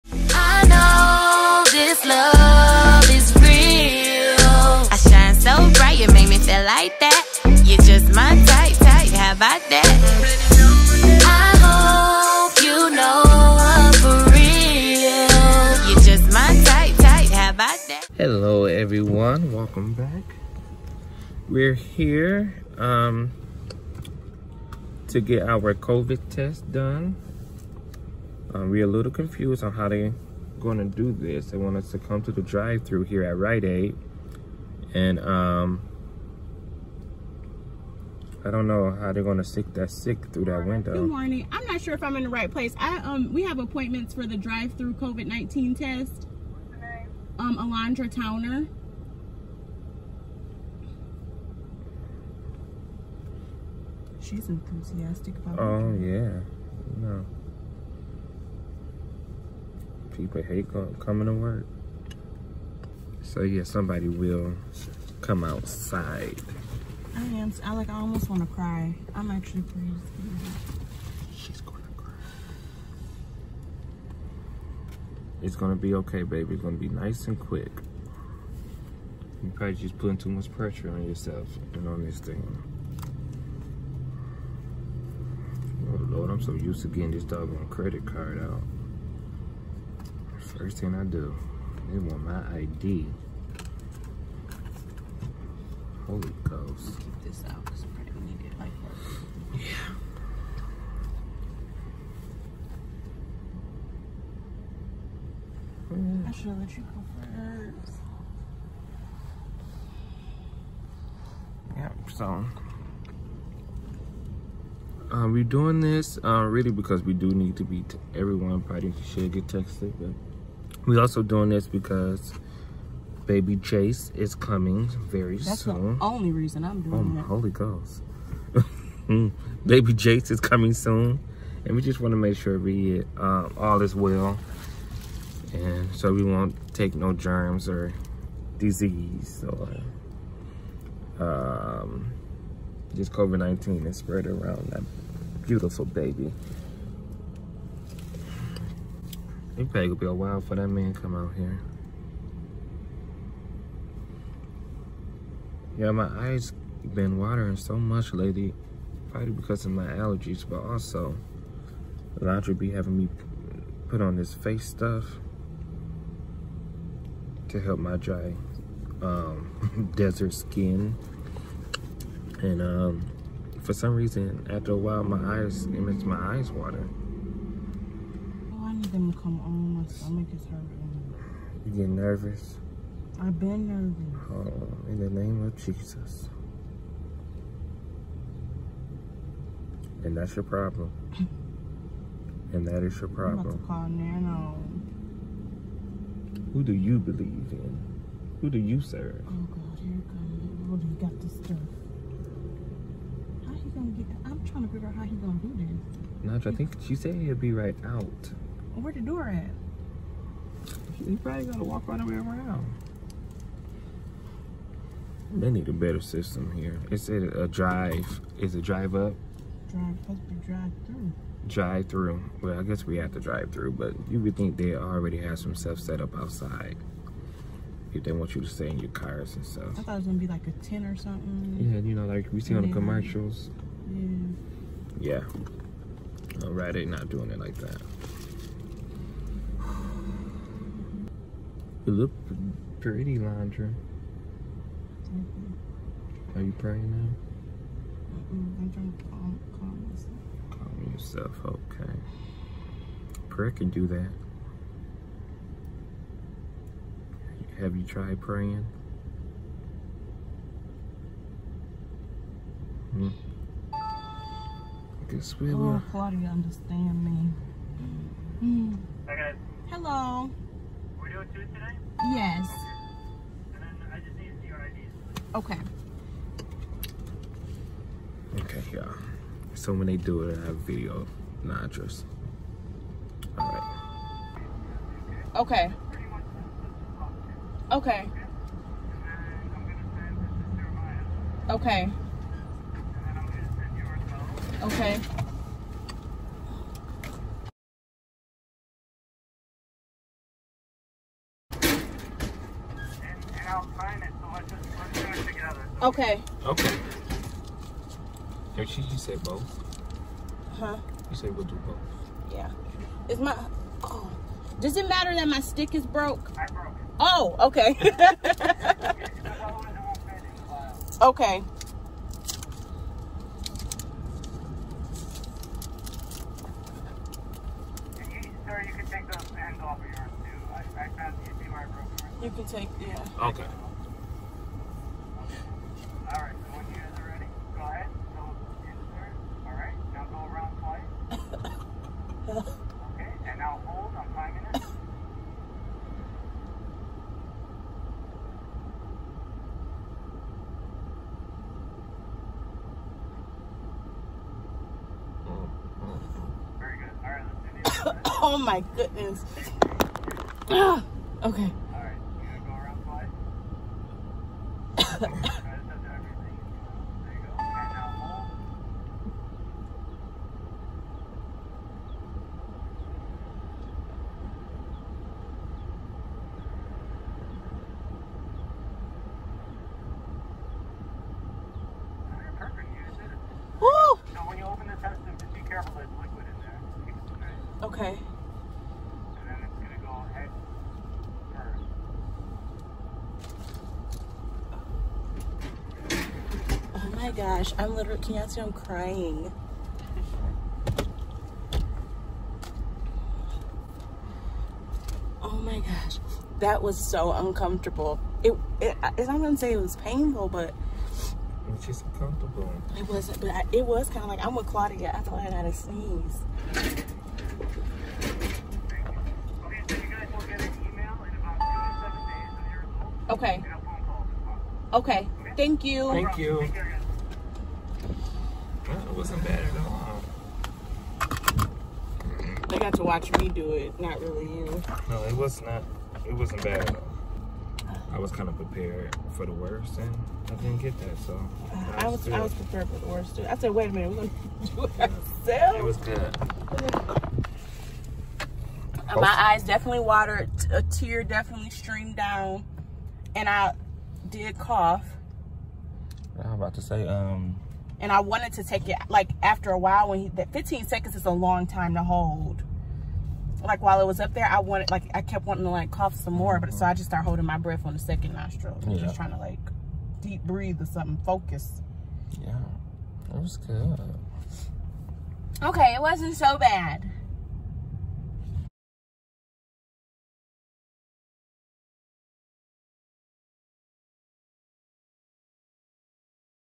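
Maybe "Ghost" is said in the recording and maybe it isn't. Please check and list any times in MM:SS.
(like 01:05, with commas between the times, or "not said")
01:36, 02:07.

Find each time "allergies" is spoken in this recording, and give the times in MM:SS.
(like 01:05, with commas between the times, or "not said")
02:39.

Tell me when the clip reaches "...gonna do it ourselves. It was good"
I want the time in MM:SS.
07:24.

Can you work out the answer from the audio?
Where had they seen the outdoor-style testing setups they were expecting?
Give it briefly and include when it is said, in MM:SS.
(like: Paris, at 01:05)
Commercials, at 03:52.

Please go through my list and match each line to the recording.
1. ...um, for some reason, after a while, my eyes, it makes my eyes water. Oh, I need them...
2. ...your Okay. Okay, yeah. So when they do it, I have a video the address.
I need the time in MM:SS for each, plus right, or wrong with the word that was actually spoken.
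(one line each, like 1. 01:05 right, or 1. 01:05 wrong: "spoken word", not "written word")
1. 02:52 right
2. 04:34 right.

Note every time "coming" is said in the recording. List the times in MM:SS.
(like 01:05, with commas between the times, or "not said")
01:00, 02:04, 02:10.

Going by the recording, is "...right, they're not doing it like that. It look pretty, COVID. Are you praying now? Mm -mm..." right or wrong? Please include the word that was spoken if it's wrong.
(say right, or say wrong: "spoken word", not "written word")
wrong: "Laundry", not "COVID".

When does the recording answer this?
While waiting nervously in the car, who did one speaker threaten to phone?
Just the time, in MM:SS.
03:13.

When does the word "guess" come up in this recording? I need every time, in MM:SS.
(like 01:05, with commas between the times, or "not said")
03:42, 04:25.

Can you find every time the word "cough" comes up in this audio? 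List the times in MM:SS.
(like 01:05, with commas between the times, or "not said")
07:34, 07:45.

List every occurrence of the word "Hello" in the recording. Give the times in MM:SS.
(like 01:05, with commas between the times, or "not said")
00:18, 04:29.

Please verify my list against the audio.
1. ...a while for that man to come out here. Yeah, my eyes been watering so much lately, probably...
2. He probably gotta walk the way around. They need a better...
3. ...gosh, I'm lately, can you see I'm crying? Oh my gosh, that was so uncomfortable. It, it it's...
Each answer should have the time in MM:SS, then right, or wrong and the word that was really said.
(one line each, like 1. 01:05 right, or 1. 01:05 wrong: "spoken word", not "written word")
1. 02:30 right
2. 03:31 right
3. 06:37 wrong: "literally", not "lately".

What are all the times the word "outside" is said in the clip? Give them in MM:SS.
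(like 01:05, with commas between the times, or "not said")
01:05, 03:46.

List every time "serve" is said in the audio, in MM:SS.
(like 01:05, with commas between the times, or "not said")
03:18.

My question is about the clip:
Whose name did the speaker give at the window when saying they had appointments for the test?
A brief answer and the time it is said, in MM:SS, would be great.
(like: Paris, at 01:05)
Alondra Towner, at 00:47.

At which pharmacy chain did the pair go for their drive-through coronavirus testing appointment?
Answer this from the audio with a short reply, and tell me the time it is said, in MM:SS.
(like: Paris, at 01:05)
Rite Aid, at 00:33.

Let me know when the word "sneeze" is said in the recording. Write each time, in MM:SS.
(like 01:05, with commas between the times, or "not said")
06:55.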